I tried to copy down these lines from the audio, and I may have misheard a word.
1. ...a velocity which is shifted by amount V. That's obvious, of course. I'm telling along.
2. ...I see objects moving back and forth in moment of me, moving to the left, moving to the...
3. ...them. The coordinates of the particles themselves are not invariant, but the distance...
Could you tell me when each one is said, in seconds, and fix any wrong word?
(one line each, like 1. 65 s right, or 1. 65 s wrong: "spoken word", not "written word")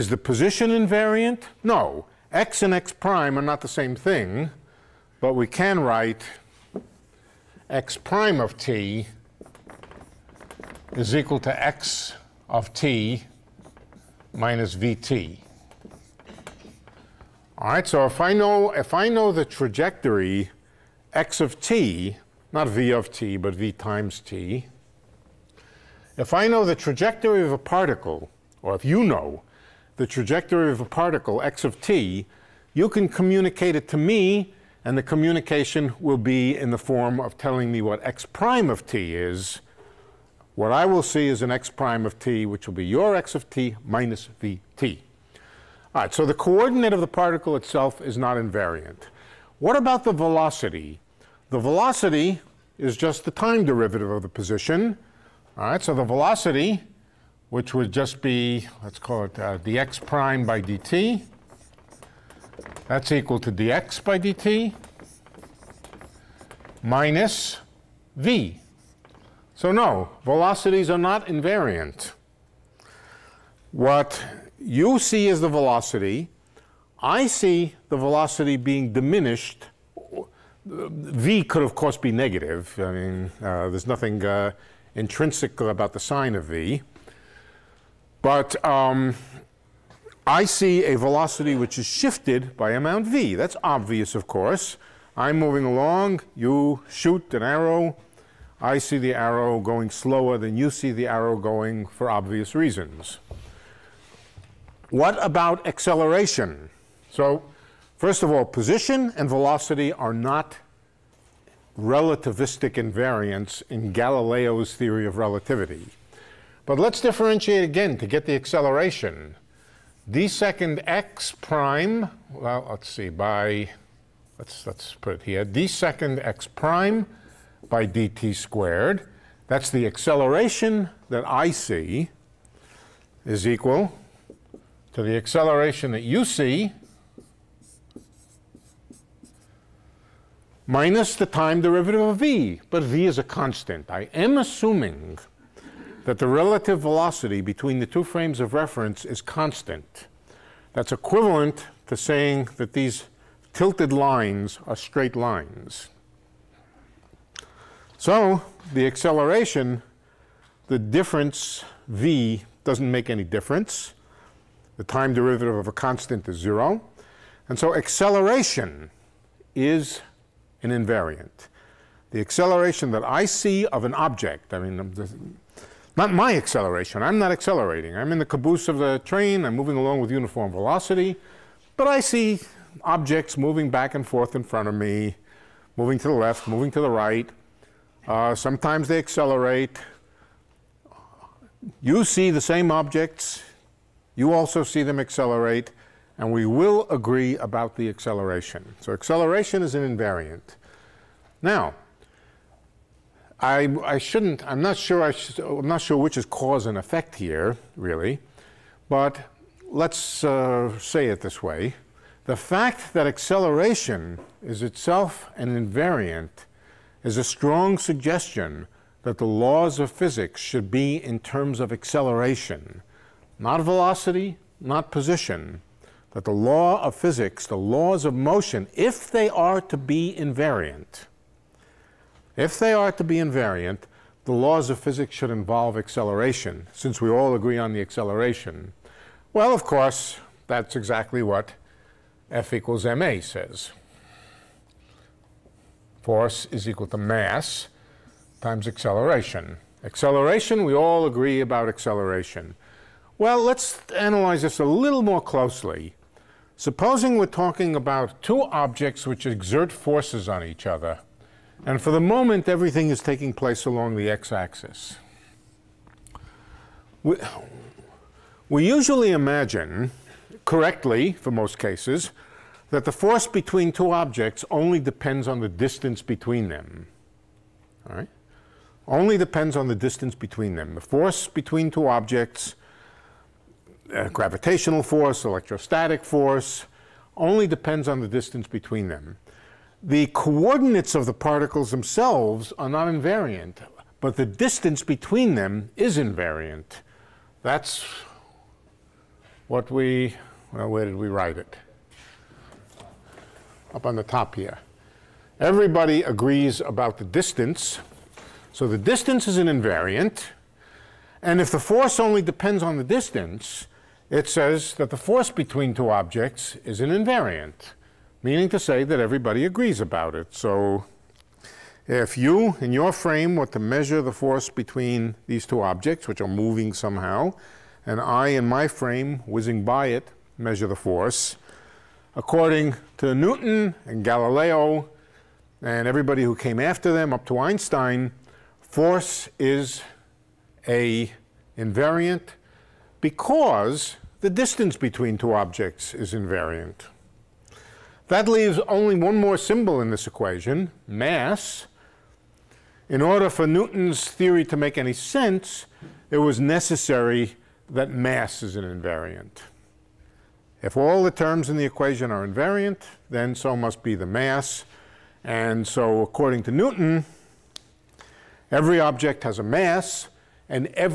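1. 90 s wrong: "moving", not "telling"
2. 181 s wrong: "front", not "moment"
3. 288 s right.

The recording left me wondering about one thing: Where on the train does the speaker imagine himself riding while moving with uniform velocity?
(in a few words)
The caboose.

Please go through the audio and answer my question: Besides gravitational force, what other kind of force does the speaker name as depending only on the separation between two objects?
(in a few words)
Electrostatic force.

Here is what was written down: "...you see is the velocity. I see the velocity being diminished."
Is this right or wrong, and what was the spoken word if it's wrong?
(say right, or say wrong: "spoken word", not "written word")
right.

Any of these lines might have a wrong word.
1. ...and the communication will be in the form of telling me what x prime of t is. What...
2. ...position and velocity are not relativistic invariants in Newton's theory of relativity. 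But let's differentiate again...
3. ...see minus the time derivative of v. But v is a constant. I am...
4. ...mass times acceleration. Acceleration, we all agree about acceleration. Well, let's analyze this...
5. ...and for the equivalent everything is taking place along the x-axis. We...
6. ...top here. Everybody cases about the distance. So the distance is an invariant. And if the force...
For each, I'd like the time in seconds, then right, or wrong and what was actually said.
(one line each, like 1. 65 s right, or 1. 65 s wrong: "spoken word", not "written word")
1. 34 s right
2. 108 s wrong: "Galileo", not "Newton"
3. 136 s right
4. 246 s right
5. 261 s wrong: "moment", not "equivalent"
6. 304 s wrong: "agrees", not "cases".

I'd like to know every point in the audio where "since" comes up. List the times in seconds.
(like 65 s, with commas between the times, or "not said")
236 s.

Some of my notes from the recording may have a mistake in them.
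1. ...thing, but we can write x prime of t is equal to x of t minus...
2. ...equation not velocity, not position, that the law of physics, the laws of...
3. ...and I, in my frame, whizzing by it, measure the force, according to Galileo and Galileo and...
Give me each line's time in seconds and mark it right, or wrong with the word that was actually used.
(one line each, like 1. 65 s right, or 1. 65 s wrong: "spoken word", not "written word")
1. 3 s right
2. 221 s wrong: "acceleration", not "equation"
3. 327 s wrong: "Newton", not "Galileo".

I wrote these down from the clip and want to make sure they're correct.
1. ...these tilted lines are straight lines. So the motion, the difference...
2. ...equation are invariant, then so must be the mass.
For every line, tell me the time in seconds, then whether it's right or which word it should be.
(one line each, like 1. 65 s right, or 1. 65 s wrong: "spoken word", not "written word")
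1. 152 s wrong: "acceleration", not "motion"
2. 361 s right.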